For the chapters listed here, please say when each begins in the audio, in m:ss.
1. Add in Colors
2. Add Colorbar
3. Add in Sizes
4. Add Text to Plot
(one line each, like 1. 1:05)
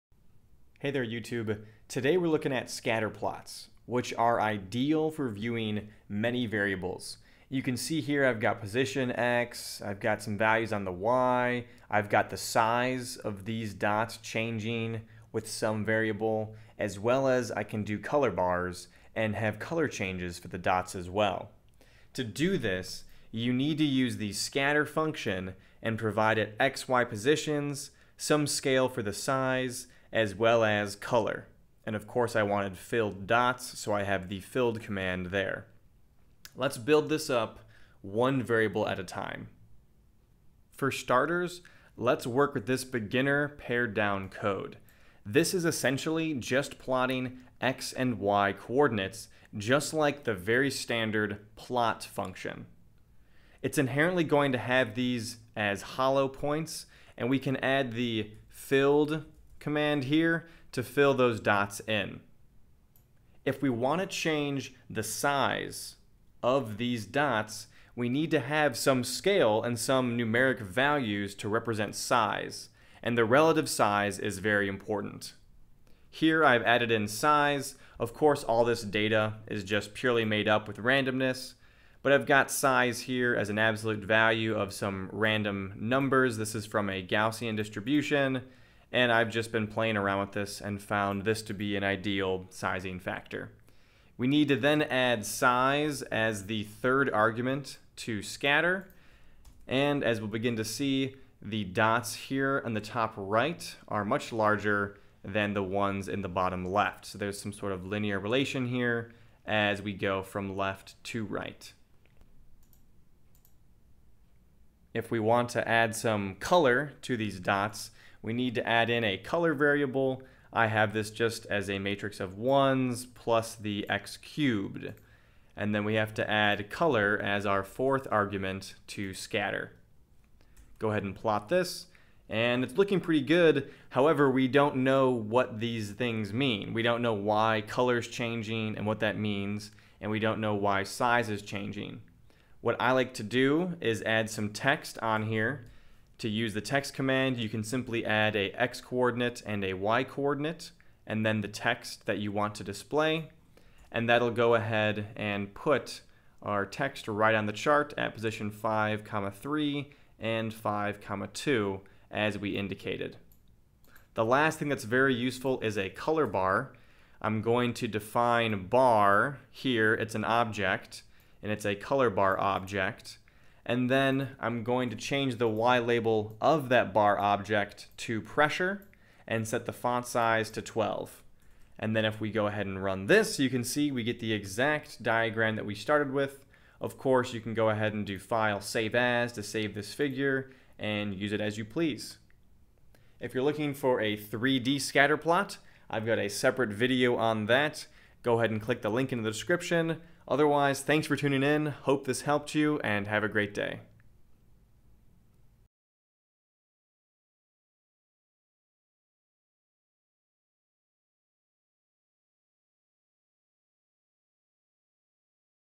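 1. 1:53
2. 2:43
3. 1:16
4. 2:13.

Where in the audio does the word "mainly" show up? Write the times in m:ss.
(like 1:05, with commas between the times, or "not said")
not said.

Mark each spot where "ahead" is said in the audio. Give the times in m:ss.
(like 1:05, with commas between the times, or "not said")
2:10, 2:34, 3:02, 3:07, 3:18.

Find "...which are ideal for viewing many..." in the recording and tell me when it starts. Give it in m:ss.
0:03.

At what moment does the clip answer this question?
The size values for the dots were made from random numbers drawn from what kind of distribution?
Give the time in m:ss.
1:27.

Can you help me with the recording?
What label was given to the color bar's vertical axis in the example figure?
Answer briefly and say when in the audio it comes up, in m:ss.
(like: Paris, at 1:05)
pressure, at 2:58.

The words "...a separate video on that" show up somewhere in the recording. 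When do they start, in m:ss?
3:16.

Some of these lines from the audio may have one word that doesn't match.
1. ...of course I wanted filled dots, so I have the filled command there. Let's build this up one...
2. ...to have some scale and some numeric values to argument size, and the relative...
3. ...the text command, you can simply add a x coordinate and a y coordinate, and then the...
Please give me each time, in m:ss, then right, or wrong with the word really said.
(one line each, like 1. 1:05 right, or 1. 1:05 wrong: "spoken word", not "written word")
1. 0:31 right
2. 1:08 wrong: "represent", not "argument"
3. 2:26 right.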